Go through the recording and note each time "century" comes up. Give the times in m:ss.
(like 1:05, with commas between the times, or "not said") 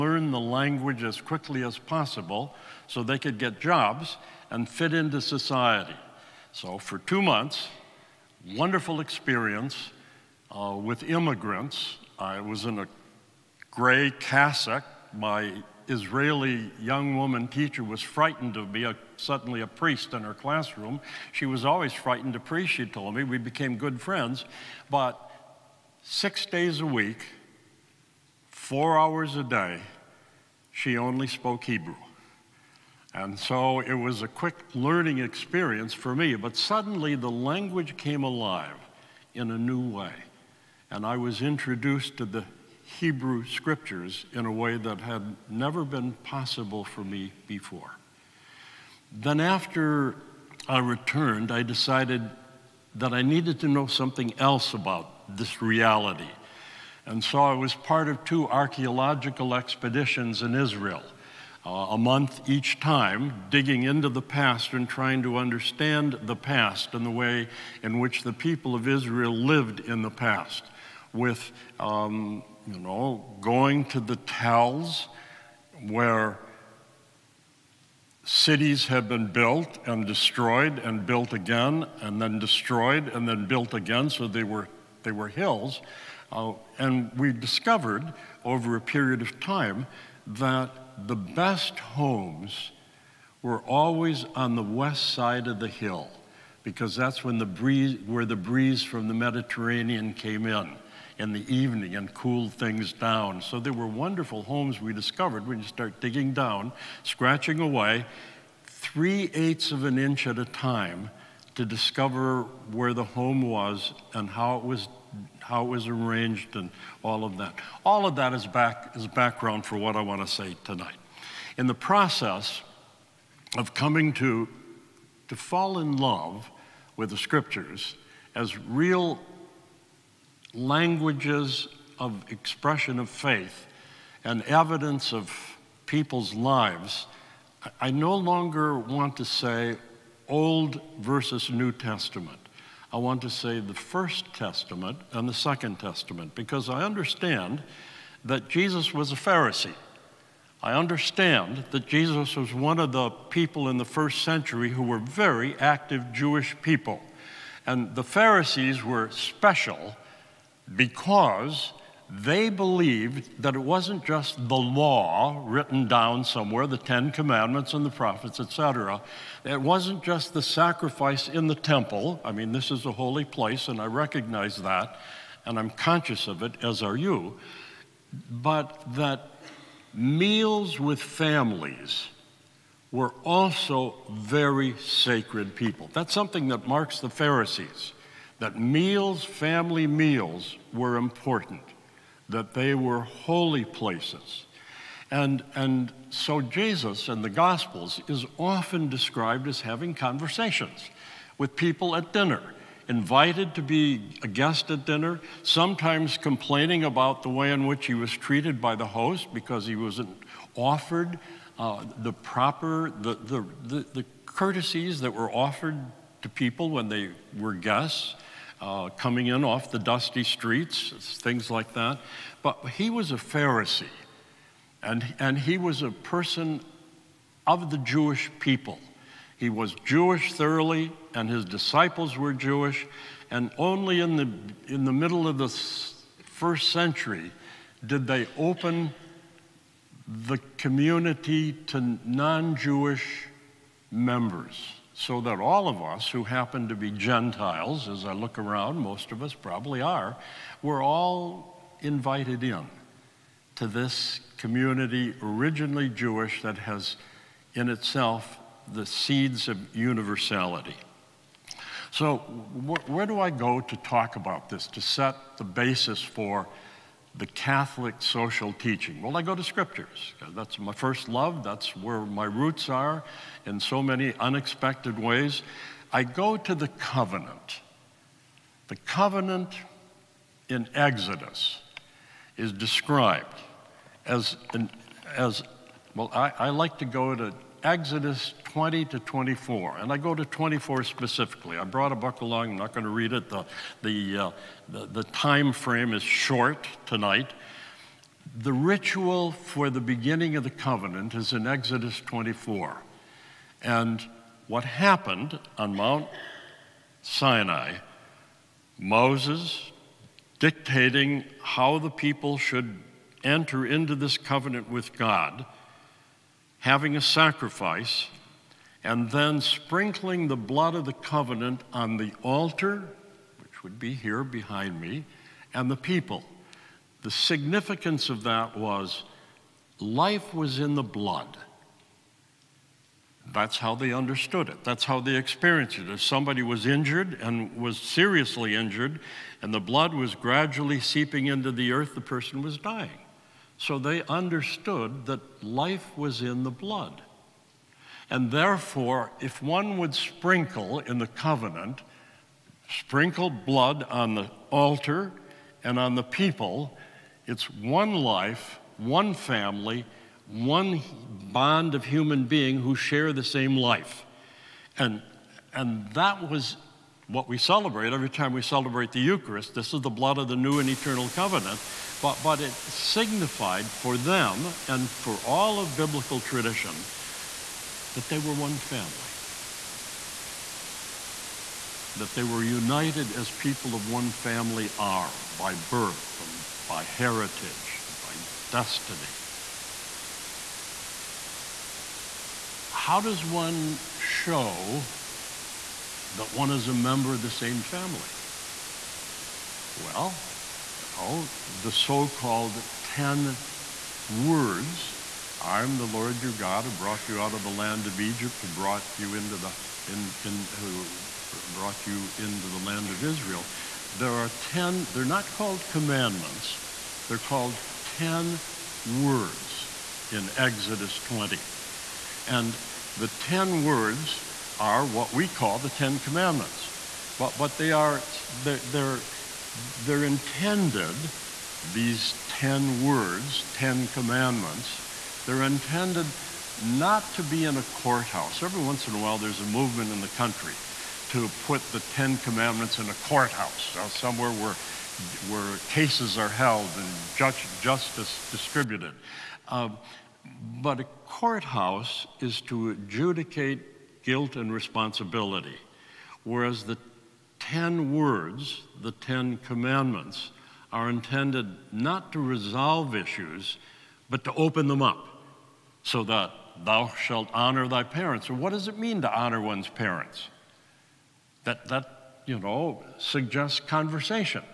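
2:34, 3:56.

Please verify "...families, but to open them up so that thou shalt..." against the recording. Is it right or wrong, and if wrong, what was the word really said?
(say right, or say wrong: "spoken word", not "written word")
wrong: "issues", not "families".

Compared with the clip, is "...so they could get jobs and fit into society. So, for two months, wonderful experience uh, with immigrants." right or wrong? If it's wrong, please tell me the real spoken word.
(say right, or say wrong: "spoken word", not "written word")
right.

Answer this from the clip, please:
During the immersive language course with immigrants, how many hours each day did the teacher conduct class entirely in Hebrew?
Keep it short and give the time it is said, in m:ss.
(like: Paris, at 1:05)
4, at 0:28.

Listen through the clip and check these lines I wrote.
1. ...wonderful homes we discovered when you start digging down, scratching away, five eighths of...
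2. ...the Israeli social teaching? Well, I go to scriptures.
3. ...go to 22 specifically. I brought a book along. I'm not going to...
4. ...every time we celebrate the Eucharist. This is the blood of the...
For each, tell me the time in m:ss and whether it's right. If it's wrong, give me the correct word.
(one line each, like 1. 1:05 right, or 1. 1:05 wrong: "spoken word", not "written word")
1. 1:43 wrong: "three", not "five"
2. 4:27 wrong: "Catholic", not "Israeli"
3. 4:49 wrong: "24", not "22"
4. 6:07 right.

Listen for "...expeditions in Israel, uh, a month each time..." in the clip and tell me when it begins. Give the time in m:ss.
0:59.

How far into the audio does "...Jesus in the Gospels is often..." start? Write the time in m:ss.
3:16.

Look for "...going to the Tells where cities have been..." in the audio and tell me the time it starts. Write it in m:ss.
1:13.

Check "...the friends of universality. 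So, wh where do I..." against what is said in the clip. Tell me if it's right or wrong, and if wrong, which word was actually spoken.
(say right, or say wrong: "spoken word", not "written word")
wrong: "seeds", not "friends".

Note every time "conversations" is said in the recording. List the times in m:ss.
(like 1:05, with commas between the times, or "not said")
3:19, 7:53.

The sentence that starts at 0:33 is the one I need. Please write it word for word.
And so it was a quick learning experience for me, but suddenly the language came alive in a new way.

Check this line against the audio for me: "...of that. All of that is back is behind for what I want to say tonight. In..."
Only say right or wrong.
wrong.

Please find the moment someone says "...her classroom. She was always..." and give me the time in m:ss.
0:20.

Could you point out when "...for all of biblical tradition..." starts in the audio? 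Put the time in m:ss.
6:14.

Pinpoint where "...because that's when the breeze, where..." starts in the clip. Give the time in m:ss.
1:36.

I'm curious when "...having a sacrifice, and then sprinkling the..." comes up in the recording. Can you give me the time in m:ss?
5:16.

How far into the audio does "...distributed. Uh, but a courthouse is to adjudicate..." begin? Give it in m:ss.
7:28.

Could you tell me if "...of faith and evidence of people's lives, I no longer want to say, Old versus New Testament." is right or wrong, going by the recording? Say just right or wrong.
right.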